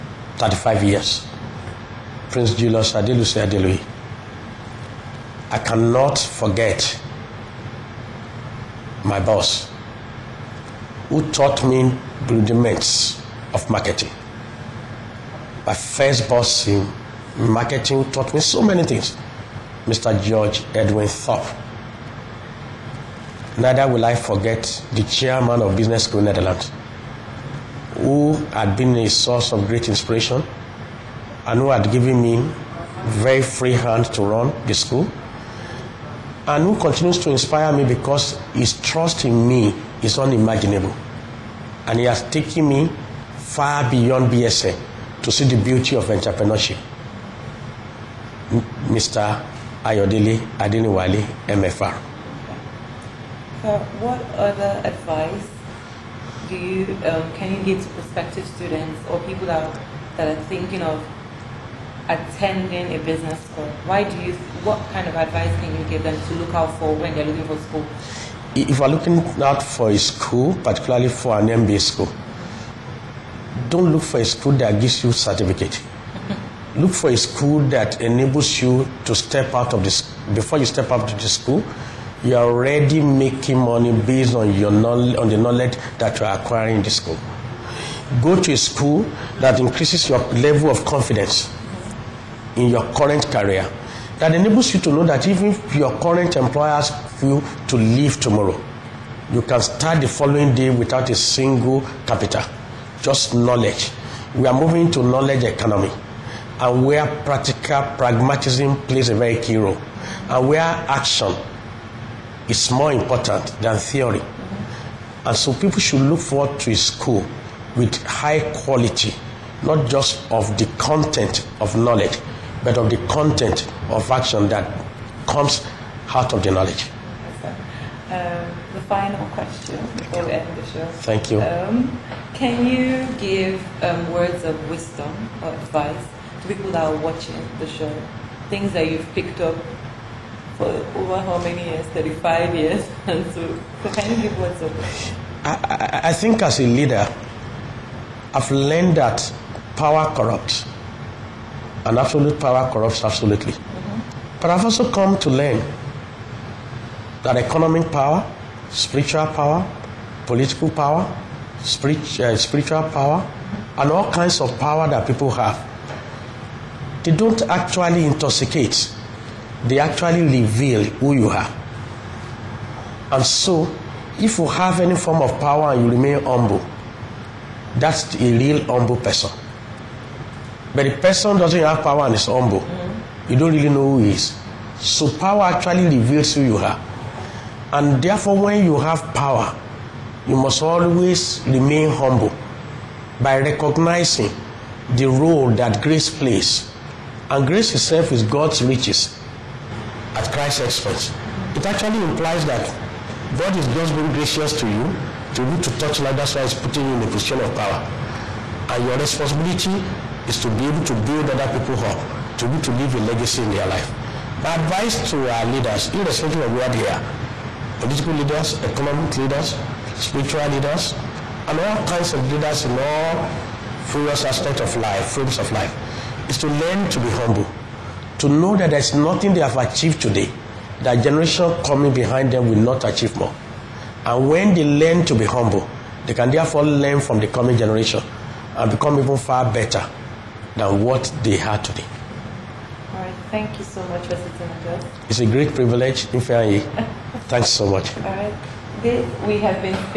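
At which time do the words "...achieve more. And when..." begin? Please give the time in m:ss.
3:52.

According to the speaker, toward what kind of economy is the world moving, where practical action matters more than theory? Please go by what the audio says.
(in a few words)
Knowledge economy.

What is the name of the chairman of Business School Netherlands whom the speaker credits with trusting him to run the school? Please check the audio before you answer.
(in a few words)
Ayodele Adeniwale.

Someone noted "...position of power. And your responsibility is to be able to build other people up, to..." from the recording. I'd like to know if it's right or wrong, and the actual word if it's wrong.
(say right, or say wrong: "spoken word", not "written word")
right.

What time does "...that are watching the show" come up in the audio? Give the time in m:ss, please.
2:16.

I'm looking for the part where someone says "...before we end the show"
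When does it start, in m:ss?
2:09.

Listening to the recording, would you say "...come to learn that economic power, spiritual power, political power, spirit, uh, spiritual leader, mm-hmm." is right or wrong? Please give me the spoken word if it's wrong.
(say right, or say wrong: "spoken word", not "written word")
wrong: "power", not "leader".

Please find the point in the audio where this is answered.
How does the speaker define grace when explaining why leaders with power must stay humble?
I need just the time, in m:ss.
3:18.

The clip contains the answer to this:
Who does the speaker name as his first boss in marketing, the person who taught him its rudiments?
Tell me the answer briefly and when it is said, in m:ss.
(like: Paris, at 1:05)
George Edwin Thorpe, at 0:20.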